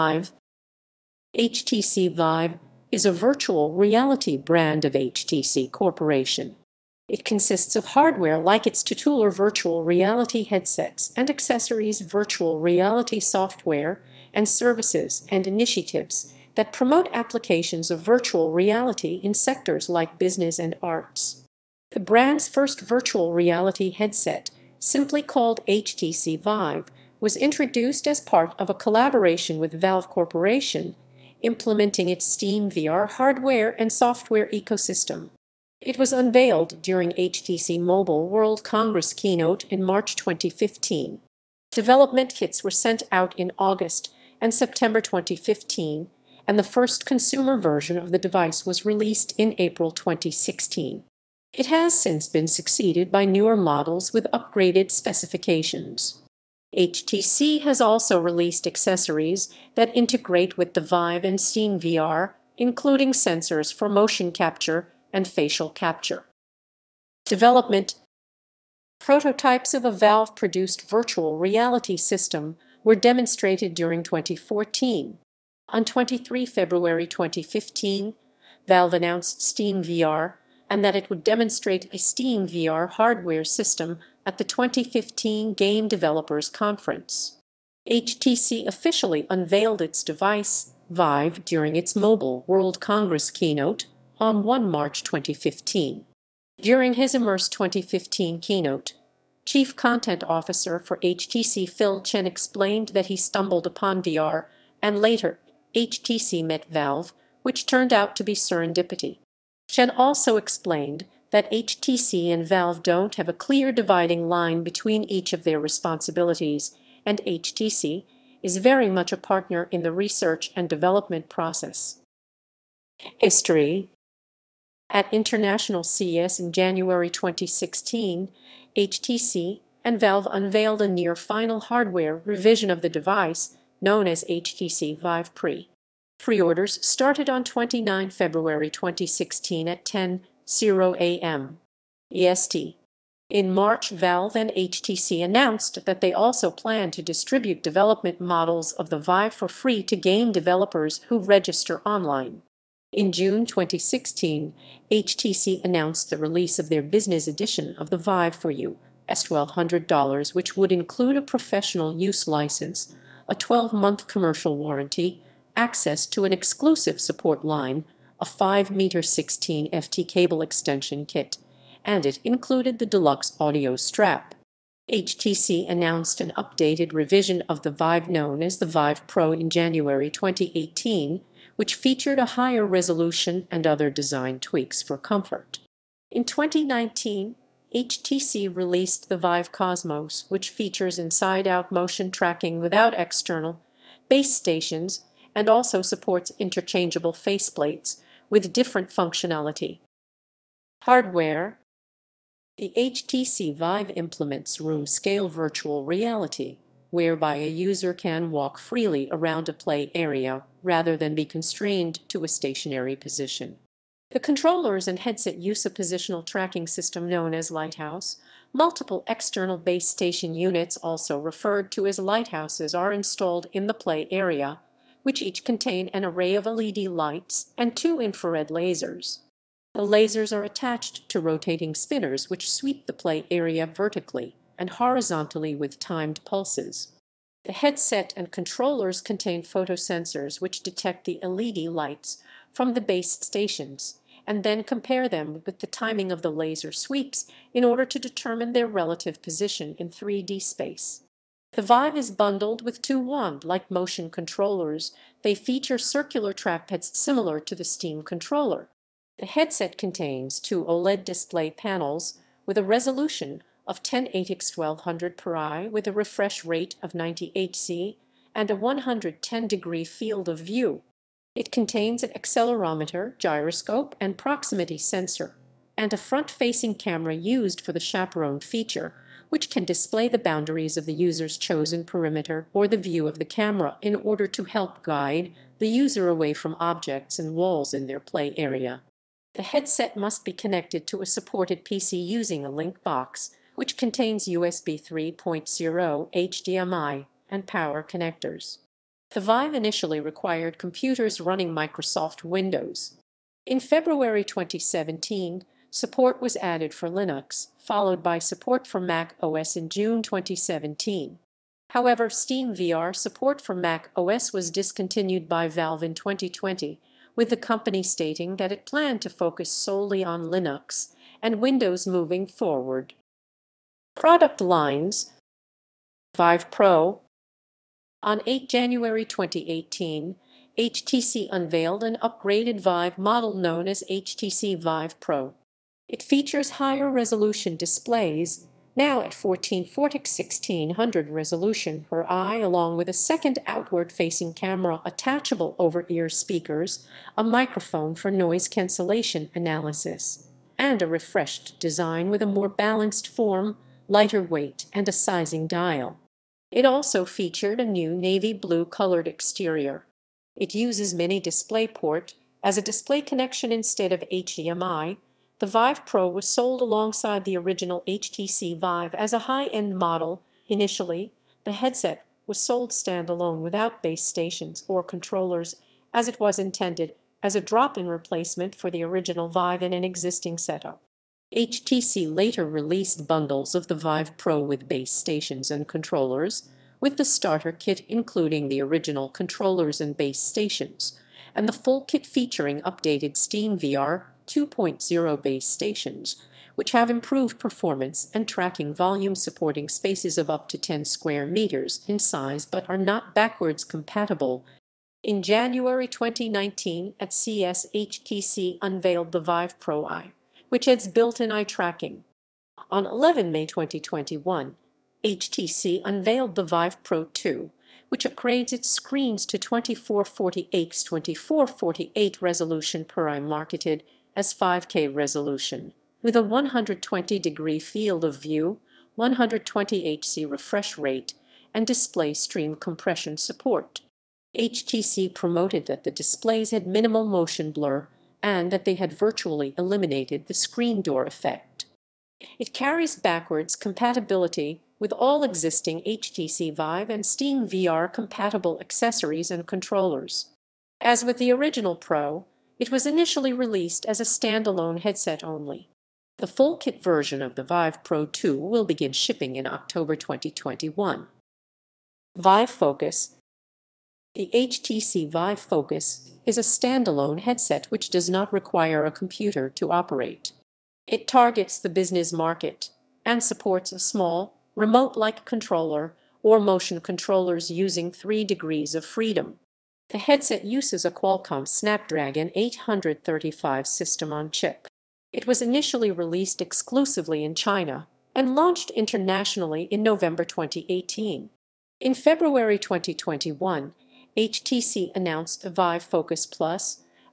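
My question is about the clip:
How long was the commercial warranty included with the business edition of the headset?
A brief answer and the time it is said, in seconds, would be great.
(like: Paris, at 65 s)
12 months, at 163 s.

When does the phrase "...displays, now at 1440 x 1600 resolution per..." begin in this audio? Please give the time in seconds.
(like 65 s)
337 s.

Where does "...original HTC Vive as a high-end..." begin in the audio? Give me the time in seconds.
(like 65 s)
367 s.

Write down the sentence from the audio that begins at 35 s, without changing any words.
It was unveiled during HTC Mobile World Congress keynote in March 2015.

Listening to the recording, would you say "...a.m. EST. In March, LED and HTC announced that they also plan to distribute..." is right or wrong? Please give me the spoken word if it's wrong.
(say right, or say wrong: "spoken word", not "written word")
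wrong: "Valve", not "LED".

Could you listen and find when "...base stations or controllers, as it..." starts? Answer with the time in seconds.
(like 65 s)
373 s.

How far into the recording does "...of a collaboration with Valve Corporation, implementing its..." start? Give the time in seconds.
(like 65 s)
28 s.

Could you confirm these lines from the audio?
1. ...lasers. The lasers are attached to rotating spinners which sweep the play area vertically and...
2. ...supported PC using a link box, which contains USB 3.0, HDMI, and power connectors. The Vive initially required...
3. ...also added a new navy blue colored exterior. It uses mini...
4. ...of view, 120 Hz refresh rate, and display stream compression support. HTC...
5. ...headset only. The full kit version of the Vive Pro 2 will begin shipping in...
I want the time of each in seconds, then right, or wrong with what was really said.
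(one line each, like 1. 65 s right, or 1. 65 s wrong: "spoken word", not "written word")
1. 228 s right
2. 291 s right
3. 356 s wrong: "featured", not "added"
4. 428 s right
5. 454 s right.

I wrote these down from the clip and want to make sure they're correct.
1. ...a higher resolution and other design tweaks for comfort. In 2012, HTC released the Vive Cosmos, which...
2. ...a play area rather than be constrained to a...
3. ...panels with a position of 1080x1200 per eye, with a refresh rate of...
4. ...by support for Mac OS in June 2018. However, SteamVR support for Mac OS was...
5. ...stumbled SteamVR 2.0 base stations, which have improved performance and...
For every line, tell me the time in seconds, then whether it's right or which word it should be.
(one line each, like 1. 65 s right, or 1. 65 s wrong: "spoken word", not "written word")
1. 182 s wrong: "2019", not "2012"
2. 209 s right
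3. 261 s wrong: "resolution", not "position"
4. 307 s wrong: "2017", not "2018"
5. 392 s wrong: "updated", not "stumbled".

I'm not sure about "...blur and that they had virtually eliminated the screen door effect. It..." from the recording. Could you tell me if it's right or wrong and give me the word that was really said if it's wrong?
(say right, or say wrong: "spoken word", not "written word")
right.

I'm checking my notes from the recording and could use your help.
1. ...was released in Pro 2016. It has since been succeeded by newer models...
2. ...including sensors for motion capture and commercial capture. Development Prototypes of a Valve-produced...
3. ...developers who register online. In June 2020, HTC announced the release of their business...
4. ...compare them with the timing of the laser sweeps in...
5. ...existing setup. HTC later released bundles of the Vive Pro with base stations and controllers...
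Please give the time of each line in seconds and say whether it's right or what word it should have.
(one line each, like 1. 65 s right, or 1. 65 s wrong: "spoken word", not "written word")
1. 48 s wrong: "April", not "Pro"
2. 62 s wrong: "facial", not "commercial"
3. 150 s wrong: "2016", not "2020"
4. 244 s right
5. 379 s right.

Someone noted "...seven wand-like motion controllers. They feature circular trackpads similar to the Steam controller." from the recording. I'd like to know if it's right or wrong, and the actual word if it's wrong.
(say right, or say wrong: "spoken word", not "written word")
wrong: "two", not "seven".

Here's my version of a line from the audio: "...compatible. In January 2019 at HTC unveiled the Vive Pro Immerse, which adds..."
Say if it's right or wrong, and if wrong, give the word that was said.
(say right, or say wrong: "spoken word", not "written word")
wrong: "Eye", not "Immerse".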